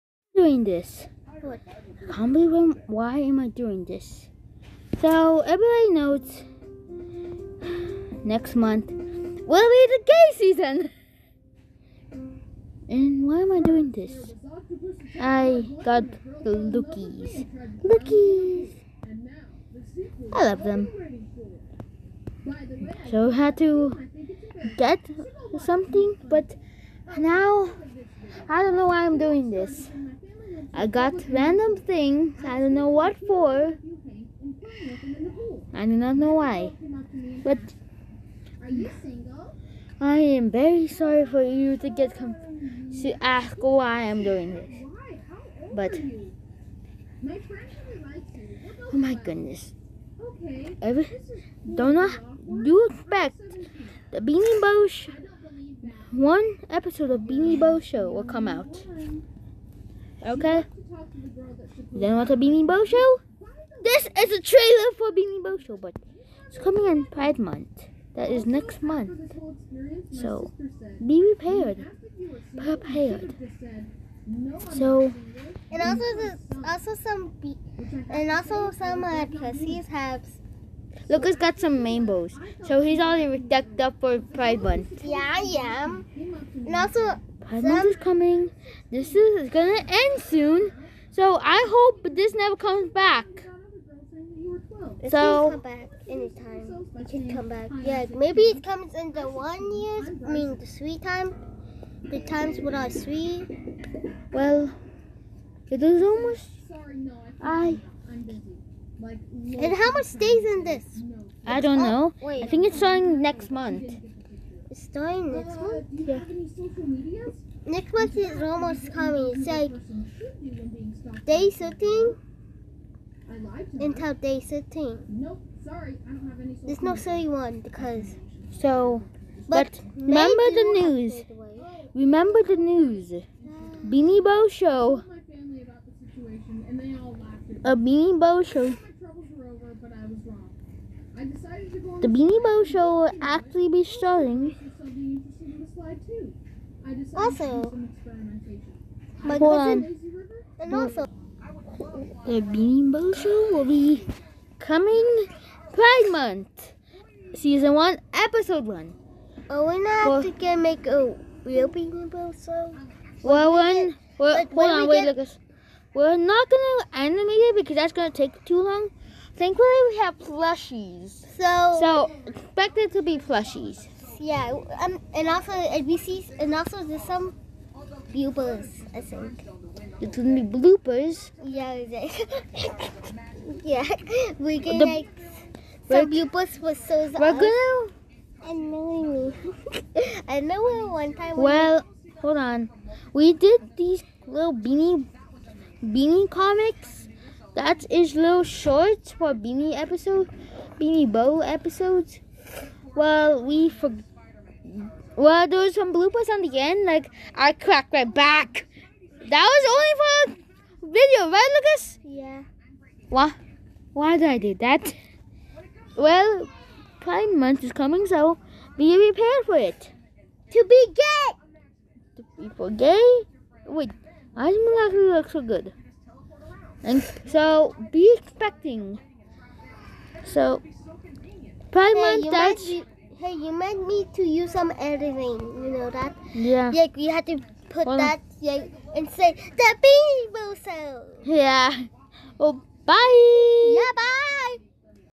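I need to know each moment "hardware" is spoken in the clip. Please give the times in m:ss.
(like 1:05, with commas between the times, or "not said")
not said.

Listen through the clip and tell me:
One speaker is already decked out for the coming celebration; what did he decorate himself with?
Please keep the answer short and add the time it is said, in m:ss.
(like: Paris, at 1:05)
rainbows, at 1:21.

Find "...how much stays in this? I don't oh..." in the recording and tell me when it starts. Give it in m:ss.
1:49.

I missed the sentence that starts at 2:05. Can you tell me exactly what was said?
No, sorry, I don't have any.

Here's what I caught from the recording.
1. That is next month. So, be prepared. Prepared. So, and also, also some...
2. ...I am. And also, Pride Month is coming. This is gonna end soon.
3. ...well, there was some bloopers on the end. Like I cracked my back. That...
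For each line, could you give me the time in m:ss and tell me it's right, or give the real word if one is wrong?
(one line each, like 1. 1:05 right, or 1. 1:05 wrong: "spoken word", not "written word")
1. 1:08 right
2. 1:25 right
3. 3:25 right.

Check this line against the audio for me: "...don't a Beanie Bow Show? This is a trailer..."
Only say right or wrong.
right.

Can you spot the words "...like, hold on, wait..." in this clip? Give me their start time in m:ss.
2:44.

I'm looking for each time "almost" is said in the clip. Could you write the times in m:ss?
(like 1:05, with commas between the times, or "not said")
1:46, 1:58.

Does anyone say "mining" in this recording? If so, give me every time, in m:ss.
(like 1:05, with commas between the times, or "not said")
not said.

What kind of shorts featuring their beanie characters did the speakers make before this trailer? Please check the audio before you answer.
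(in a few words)
comics.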